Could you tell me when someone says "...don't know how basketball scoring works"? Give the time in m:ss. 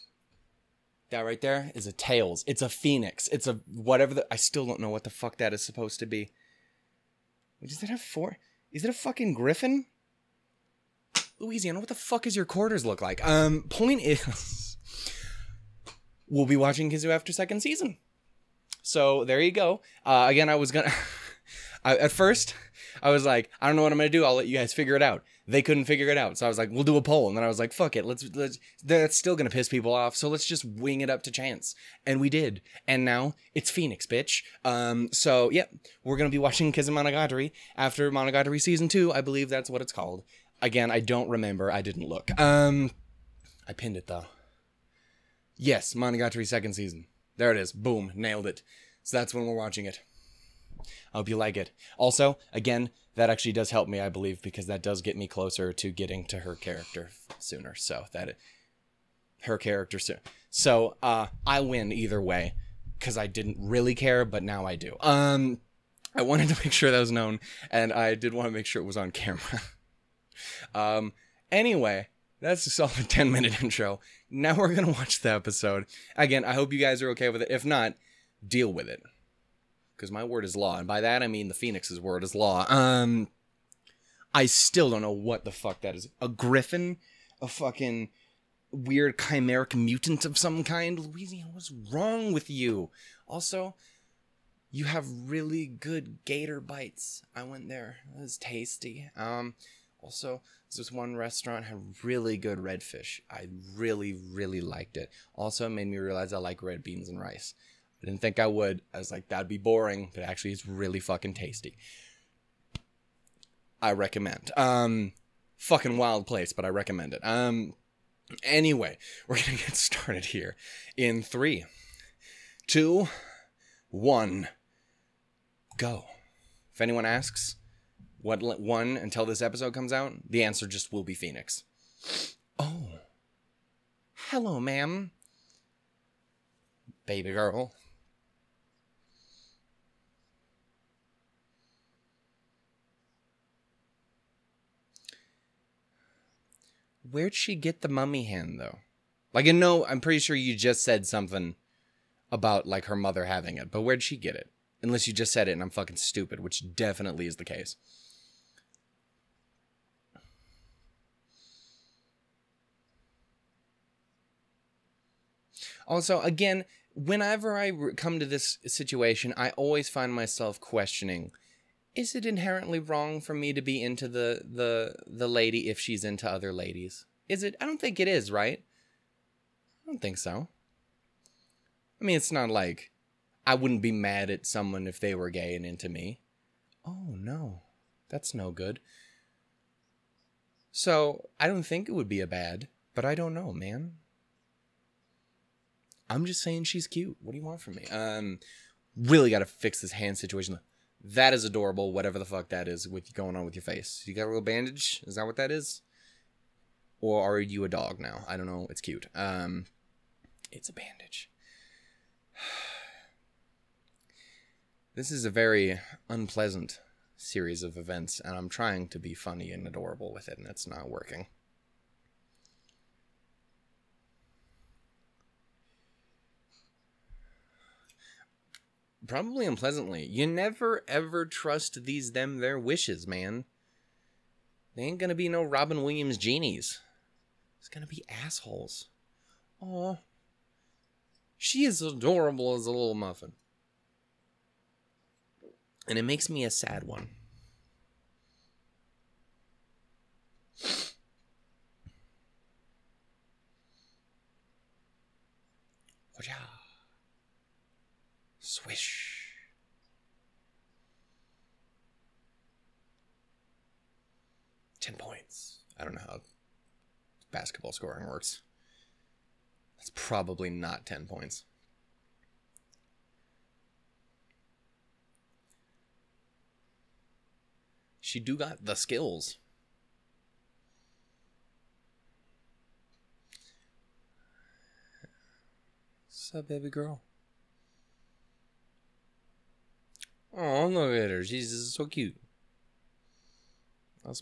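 4:25.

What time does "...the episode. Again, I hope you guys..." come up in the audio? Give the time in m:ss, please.
1:15.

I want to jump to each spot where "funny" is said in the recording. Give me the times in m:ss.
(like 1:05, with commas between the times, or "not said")
3:39.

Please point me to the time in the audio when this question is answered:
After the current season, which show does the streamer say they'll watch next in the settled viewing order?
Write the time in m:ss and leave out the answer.
0:45.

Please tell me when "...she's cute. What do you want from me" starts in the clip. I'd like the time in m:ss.
3:16.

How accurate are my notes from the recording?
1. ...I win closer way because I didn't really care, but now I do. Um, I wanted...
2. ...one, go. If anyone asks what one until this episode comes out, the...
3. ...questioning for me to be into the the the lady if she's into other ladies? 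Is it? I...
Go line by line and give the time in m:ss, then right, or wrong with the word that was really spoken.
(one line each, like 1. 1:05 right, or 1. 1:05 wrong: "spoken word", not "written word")
1. 1:01 wrong: "either", not "closer"
2. 2:03 right
3. 2:52 wrong: "wrong", not "questioning".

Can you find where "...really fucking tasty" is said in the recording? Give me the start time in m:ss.
1:50.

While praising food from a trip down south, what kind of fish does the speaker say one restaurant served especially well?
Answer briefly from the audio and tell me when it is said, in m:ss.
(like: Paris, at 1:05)
redfish, at 1:42.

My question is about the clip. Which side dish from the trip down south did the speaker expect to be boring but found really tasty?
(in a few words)
red beans and rice.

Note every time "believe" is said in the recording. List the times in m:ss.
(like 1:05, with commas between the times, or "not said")
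0:39, 0:54.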